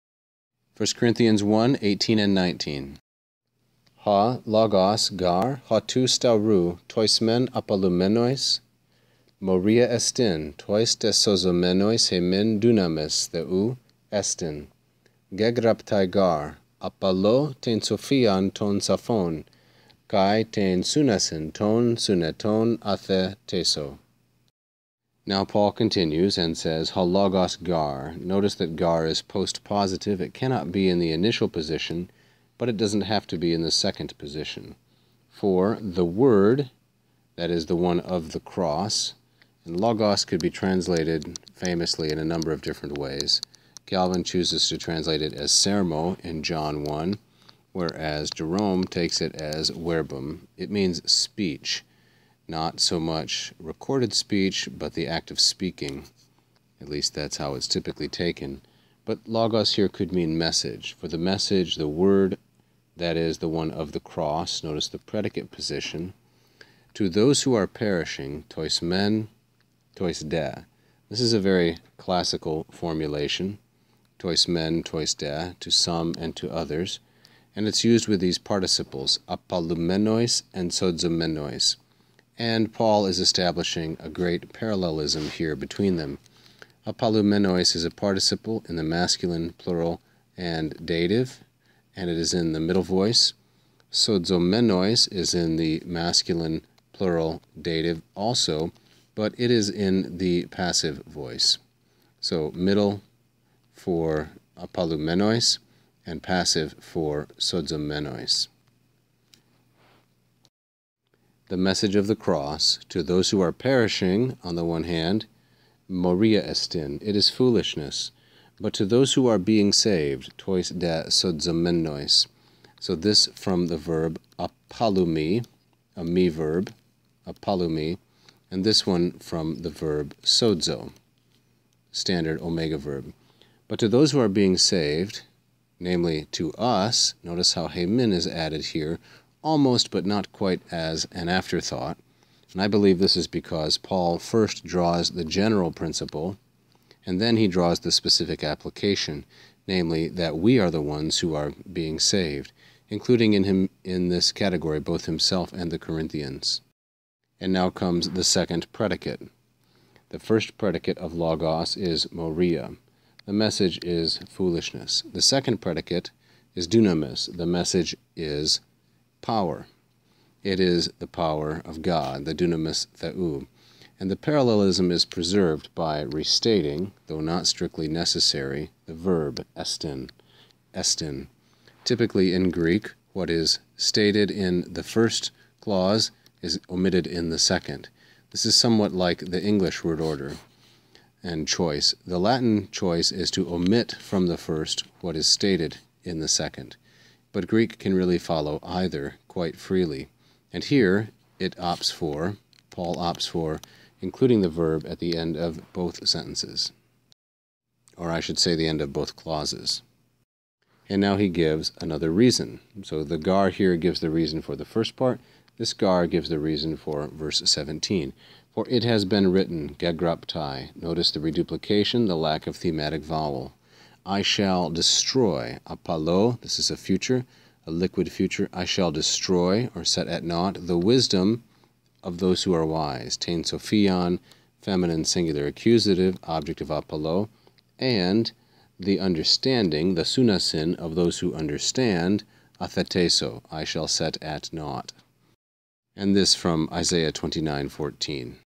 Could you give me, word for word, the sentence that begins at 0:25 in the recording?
Now Paul continues and says, halogos gar.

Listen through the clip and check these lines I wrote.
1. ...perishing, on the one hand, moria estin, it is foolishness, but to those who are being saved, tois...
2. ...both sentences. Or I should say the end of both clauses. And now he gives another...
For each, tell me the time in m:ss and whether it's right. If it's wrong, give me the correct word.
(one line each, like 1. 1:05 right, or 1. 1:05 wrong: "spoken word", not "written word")
1. 1:53 right
2. 3:25 right.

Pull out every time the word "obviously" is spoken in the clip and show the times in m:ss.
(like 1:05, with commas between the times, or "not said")
not said.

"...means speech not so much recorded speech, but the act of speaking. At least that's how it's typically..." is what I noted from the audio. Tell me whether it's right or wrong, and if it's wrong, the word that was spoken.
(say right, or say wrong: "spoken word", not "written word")
right.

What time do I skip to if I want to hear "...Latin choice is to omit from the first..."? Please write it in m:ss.
3:12.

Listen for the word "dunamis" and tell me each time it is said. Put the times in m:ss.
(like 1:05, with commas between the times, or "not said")
0:12, 2:46, 2:52.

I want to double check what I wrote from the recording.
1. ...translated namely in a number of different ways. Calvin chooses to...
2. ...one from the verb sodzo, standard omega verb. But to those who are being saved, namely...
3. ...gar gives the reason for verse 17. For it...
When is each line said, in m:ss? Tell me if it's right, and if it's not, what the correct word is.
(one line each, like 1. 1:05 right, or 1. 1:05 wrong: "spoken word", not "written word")
1. 0:40 wrong: "famously", not "namely"
2. 2:08 right
3. 3:35 right.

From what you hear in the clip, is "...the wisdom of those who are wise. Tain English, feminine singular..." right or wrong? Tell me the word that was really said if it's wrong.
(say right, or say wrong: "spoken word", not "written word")
wrong: "Sophion", not "English".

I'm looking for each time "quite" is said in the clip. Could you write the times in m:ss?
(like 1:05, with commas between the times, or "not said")
2:20, 3:19.